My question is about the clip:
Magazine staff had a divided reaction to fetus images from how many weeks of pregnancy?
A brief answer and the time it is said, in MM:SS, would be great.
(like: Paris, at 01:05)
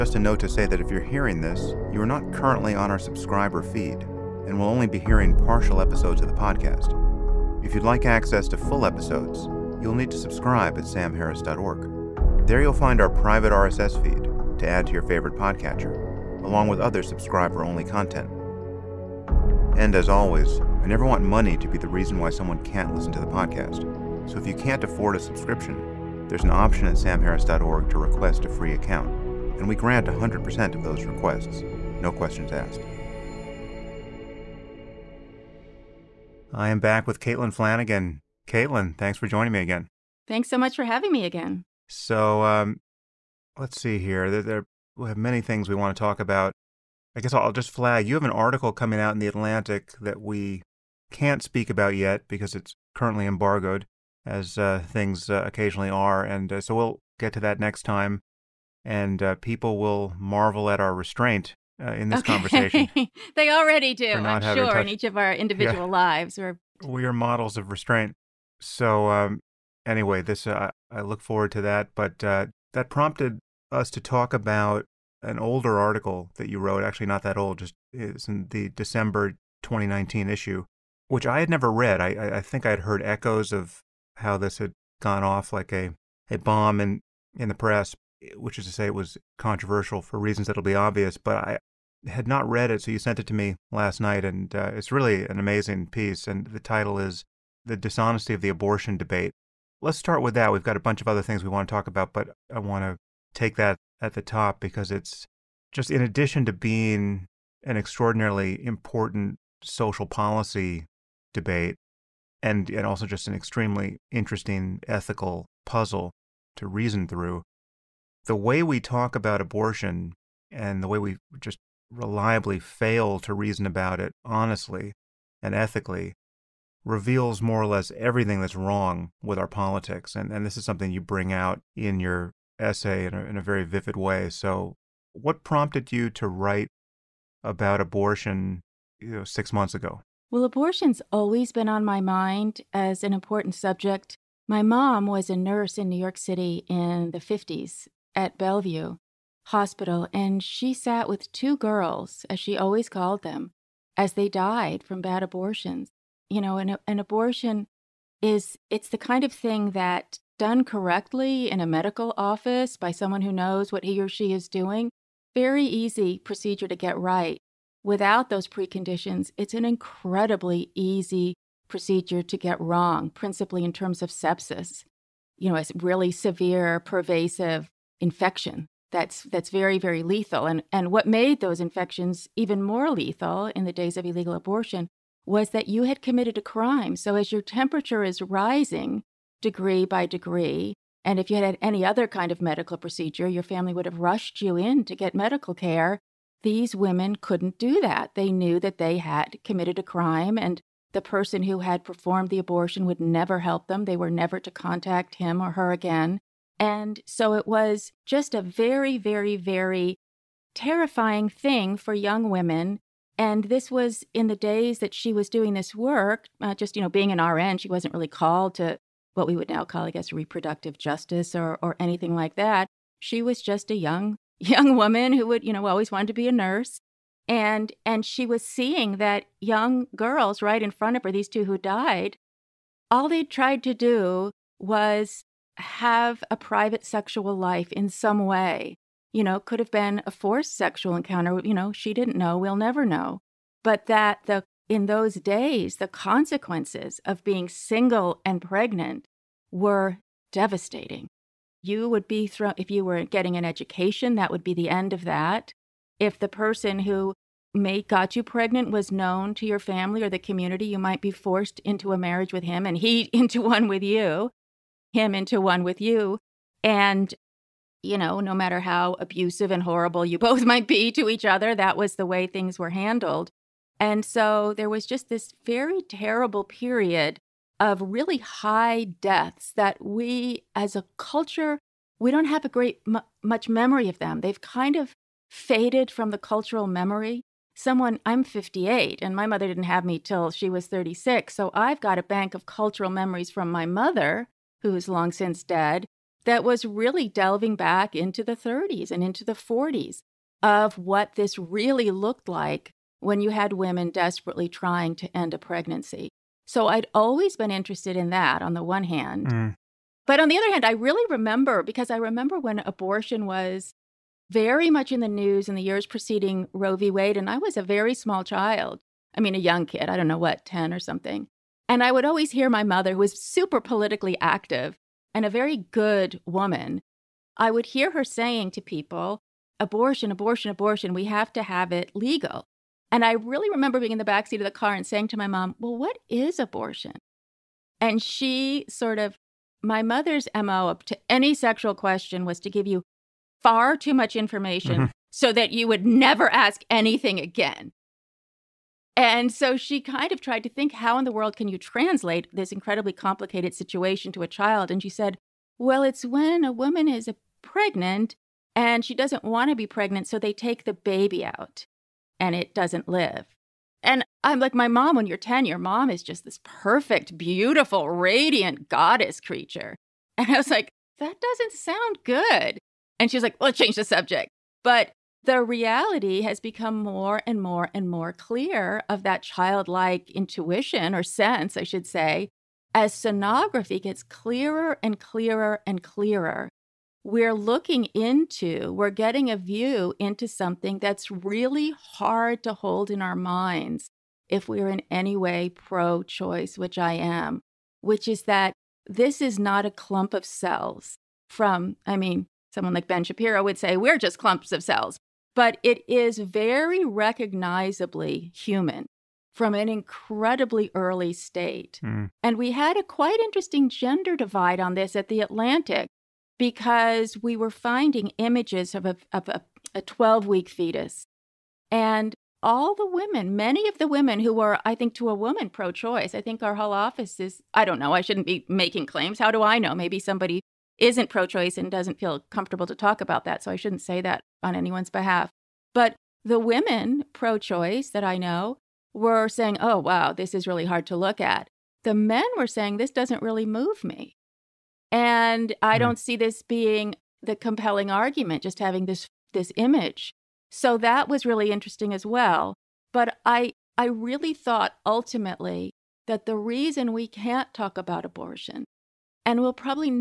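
12 weeks, at 06:59.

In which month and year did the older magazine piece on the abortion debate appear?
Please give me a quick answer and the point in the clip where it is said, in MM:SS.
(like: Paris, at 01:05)
December 2019, at 01:18.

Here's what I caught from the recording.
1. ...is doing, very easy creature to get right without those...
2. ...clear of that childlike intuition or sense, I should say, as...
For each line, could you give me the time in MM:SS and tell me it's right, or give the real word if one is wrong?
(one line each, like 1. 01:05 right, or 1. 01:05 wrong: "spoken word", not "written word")
1. 02:44 wrong: "procedure", not "creature"
2. 06:18 right.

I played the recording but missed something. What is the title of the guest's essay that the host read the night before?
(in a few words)
The Dishonesty of the Abortion Debate.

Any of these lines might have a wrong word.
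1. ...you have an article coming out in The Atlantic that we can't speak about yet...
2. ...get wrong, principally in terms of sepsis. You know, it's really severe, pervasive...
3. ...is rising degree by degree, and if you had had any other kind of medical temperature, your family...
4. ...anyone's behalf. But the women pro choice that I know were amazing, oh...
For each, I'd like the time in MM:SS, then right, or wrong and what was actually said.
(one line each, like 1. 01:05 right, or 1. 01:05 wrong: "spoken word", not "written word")
1. 00:48 right
2. 02:52 right
3. 03:08 wrong: "procedure", not "temperature"
4. 07:14 wrong: "saying", not "amazing".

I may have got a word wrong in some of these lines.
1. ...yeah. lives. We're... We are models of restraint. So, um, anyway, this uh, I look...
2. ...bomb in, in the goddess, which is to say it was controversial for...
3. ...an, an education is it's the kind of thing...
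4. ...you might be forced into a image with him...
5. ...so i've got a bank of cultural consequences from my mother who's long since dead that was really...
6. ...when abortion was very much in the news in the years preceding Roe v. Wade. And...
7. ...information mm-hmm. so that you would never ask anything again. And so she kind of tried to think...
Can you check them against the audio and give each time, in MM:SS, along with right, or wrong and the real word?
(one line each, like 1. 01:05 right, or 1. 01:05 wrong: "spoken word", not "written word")
1. 01:05 right
2. 01:26 wrong: "press", not "goddess"
3. 02:36 wrong: "abortion", not "education"
4. 04:20 wrong: "marriage", not "image"
5. 04:51 wrong: "memories", not "consequences"
6. 05:12 right
7. 05:44 right.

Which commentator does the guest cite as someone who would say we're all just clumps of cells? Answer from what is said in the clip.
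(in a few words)
Ben Shapiro.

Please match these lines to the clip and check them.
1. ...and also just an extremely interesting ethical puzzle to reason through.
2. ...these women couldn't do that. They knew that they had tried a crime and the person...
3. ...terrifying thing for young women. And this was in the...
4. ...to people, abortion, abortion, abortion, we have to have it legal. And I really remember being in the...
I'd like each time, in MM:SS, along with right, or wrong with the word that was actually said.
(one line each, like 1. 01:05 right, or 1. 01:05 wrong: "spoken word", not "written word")
1. 01:52 right
2. 03:16 wrong: "committed", not "tried"
3. 03:30 right
4. 05:28 right.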